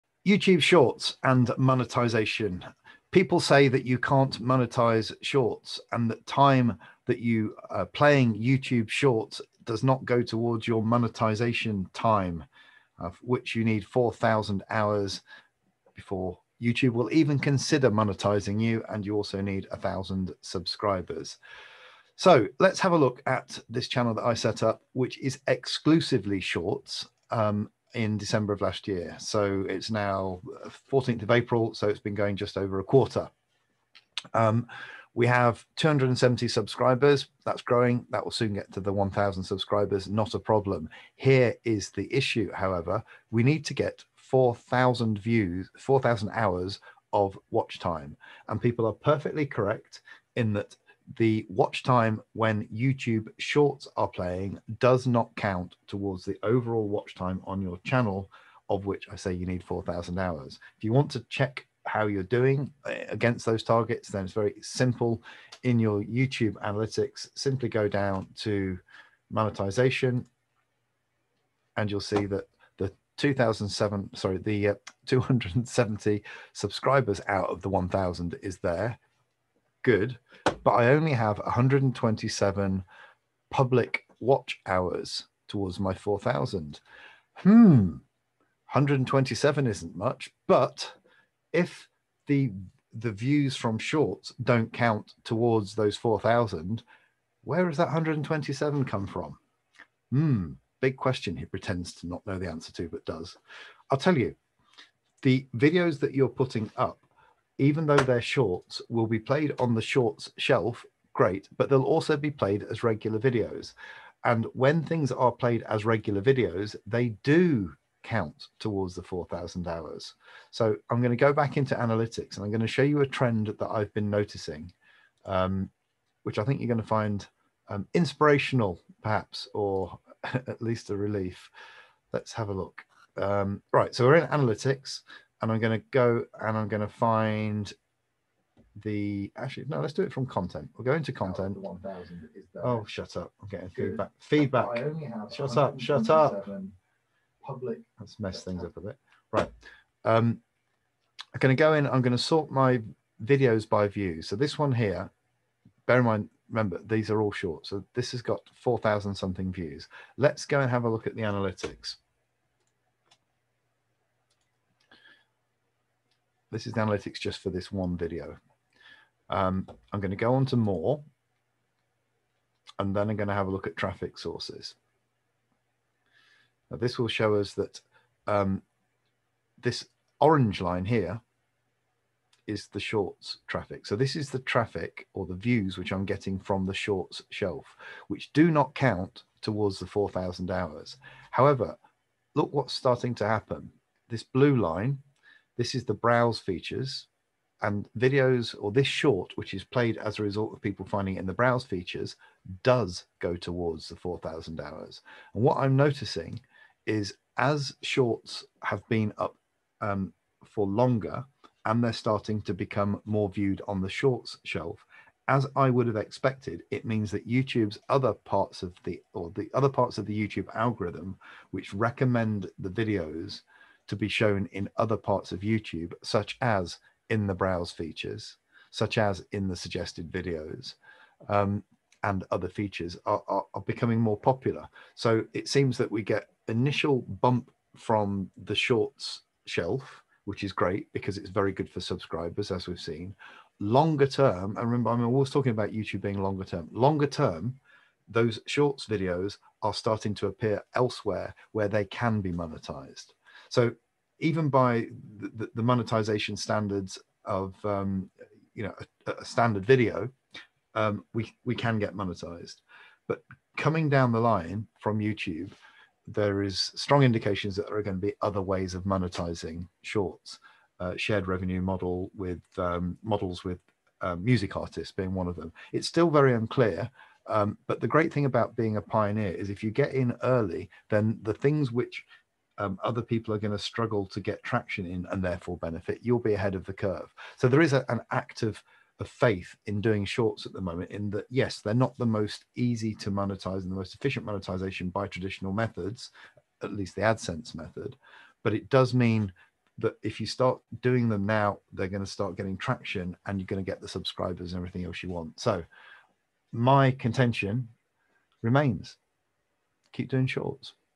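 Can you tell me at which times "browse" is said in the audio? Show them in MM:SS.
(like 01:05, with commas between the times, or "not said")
03:15, 03:21, 03:47.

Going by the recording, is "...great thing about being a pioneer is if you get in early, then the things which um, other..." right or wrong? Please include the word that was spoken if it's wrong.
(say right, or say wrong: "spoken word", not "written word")
right.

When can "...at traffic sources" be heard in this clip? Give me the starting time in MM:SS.
02:53.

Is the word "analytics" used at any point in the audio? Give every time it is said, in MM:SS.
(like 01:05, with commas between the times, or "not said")
01:06, 02:01, 02:14, 02:41, 02:46.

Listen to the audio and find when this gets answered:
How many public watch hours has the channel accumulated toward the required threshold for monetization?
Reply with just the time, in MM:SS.
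01:21.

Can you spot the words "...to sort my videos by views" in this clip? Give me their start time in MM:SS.
02:32.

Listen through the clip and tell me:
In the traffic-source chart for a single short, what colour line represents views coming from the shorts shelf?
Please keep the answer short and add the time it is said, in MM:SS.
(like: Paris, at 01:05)
Orange, at 03:00.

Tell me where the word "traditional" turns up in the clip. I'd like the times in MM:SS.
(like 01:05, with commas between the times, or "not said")
04:55.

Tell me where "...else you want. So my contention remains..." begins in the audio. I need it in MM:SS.
05:04.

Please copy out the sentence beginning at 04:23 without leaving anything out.
But coming down the line from YouTube, there is strong indications that there are going to be other ways of monetizing shorts.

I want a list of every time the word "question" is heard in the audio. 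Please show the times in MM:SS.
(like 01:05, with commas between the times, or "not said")
01:40.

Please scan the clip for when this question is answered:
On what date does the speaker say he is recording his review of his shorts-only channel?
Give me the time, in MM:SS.
00:30.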